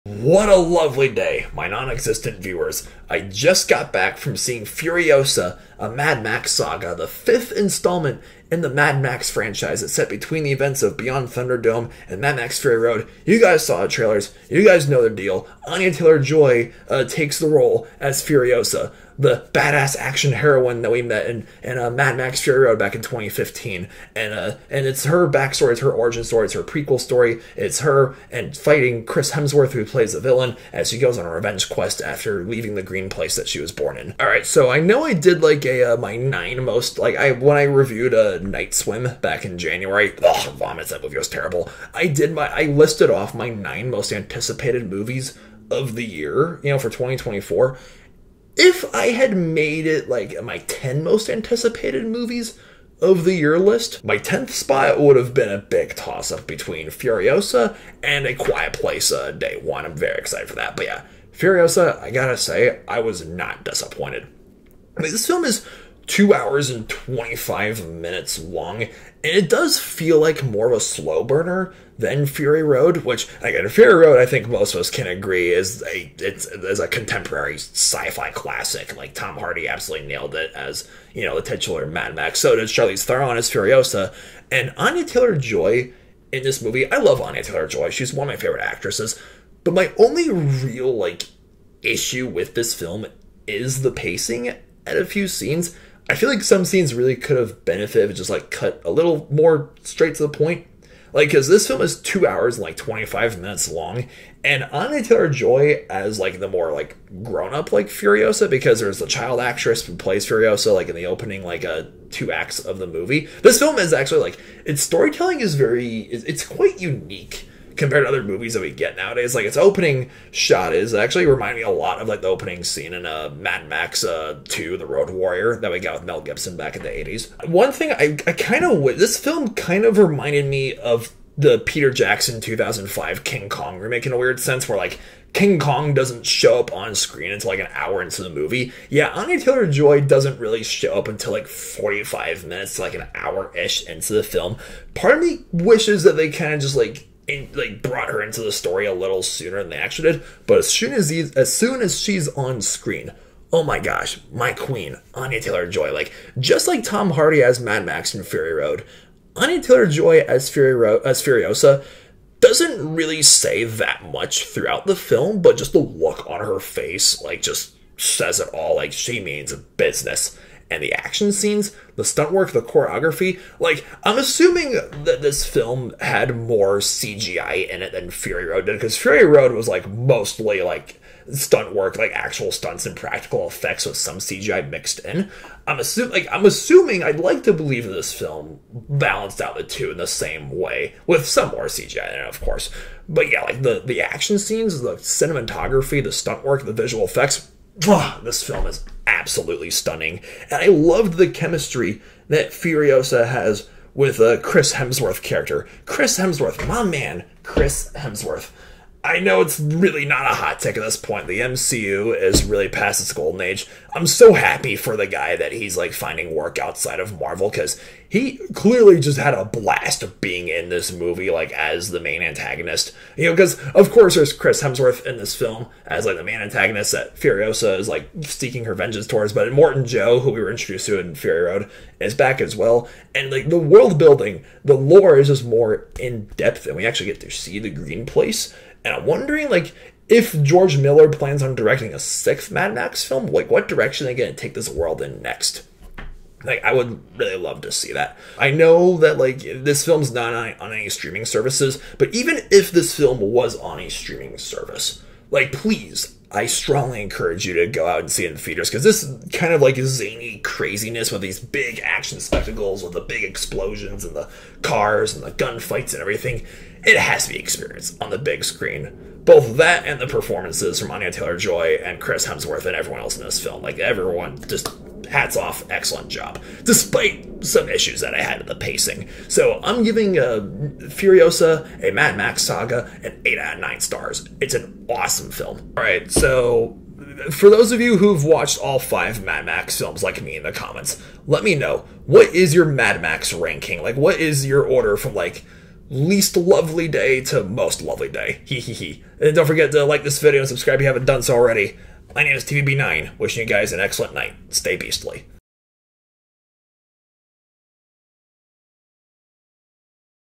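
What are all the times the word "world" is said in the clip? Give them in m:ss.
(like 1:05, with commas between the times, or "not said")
3:53, 4:04.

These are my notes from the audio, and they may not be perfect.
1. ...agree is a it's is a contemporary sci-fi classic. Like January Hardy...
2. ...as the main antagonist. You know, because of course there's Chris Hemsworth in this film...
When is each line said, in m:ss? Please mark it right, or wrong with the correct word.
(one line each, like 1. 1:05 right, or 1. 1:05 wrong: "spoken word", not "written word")
1. 1:15 wrong: "Tom", not "January"
2. 3:41 right.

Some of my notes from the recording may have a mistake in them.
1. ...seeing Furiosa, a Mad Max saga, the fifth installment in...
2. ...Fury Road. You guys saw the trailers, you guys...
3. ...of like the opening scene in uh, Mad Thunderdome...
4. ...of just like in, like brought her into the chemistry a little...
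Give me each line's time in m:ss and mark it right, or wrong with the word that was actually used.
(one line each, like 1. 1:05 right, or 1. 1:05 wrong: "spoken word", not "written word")
1. 0:04 right
2. 0:12 right
3. 2:01 wrong: "Max", not "Thunderdome"
4. 2:26 wrong: "story", not "chemistry".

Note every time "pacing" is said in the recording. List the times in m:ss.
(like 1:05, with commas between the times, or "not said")
1:33, 4:38.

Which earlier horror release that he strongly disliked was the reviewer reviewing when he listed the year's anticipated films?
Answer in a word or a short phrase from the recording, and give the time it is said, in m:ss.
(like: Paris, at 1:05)
Night Swim, at 0:38.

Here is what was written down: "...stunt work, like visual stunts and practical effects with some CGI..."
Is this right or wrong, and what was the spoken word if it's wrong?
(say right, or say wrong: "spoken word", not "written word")
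wrong: "actual", not "visual".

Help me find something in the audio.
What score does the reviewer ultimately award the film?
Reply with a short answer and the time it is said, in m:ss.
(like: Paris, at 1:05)
8 out of 9 stars, at 4:43.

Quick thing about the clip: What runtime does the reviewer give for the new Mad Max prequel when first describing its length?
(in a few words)
2 hours and 25 minutes.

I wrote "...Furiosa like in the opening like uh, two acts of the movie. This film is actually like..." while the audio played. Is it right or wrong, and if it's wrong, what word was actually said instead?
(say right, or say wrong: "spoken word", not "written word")
right.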